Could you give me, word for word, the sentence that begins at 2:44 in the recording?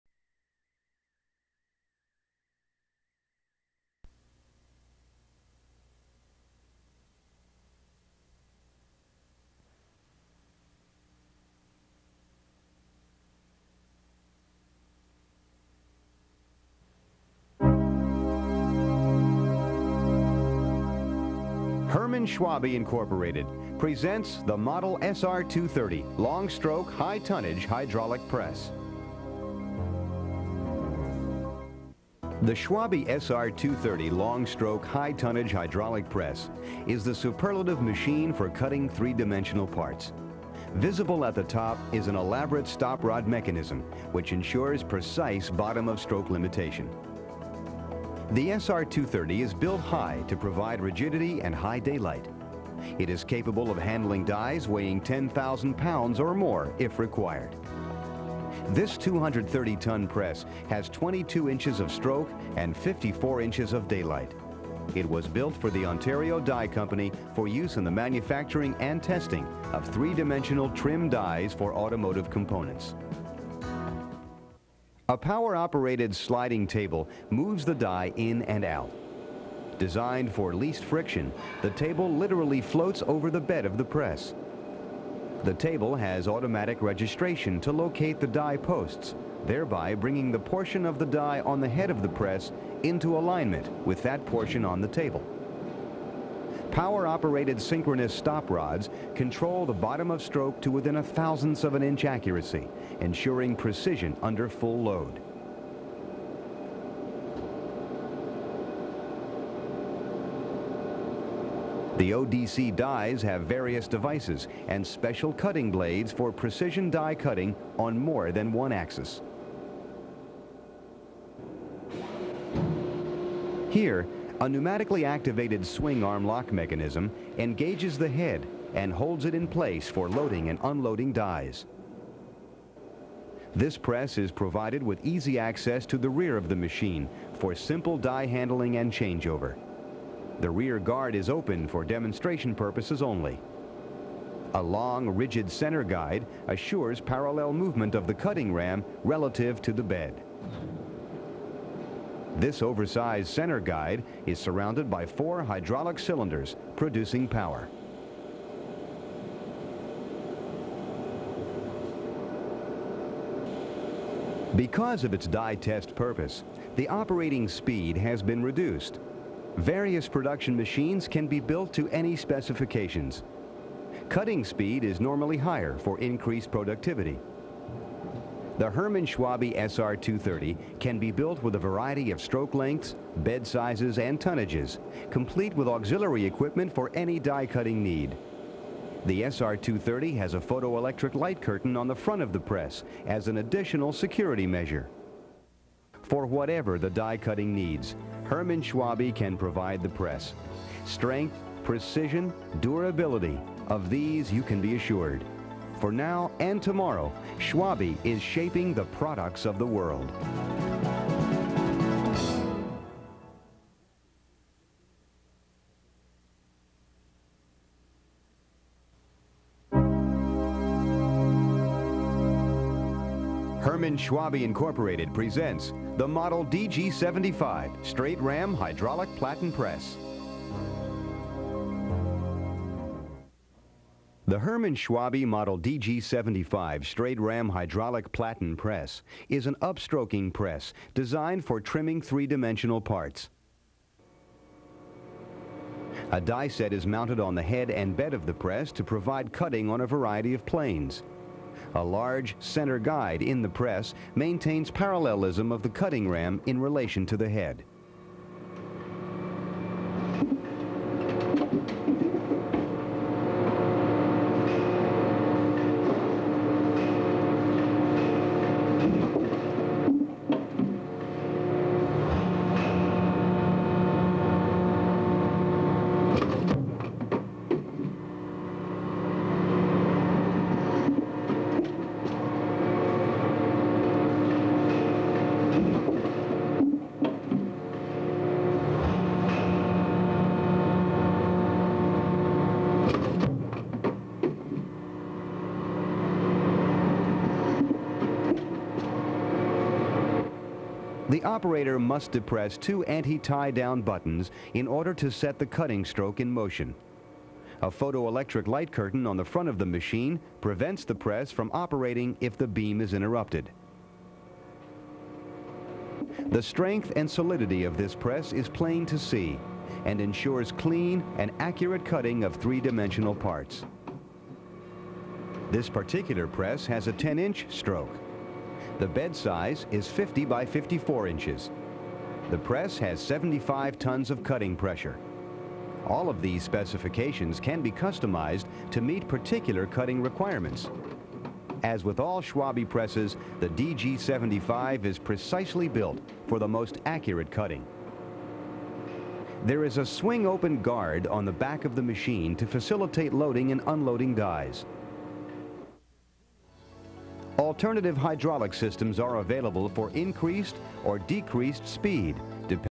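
Because of its die test purpose, the operating speed has been reduced.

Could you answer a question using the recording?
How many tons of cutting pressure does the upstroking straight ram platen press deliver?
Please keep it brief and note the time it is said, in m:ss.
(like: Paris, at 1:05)
75 tons, at 5:32.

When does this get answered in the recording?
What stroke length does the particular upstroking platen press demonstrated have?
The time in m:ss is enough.
5:26.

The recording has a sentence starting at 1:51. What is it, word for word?
The ODC dies have various devices and special cutting blades for precision die cutting on more than one axis.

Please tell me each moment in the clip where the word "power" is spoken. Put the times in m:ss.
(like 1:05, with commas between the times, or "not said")
1:15, 1:36, 2:37.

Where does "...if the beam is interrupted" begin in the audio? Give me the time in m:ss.
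5:12.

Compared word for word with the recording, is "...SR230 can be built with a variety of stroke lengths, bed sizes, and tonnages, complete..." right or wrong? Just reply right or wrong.
right.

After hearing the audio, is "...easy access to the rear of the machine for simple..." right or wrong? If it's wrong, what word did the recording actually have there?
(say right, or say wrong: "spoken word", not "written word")
right.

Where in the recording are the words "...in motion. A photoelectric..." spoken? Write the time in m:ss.
5:06.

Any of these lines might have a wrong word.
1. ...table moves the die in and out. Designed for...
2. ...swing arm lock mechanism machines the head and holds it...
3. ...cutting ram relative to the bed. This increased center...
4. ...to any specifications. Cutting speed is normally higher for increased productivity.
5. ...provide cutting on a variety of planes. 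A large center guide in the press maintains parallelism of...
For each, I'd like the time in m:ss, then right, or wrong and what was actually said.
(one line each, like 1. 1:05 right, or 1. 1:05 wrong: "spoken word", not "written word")
1. 1:16 right
2. 2:05 wrong: "engages", not "machines"
3. 2:28 wrong: "oversized", not "increased"
4. 2:51 right
5. 4:08 right.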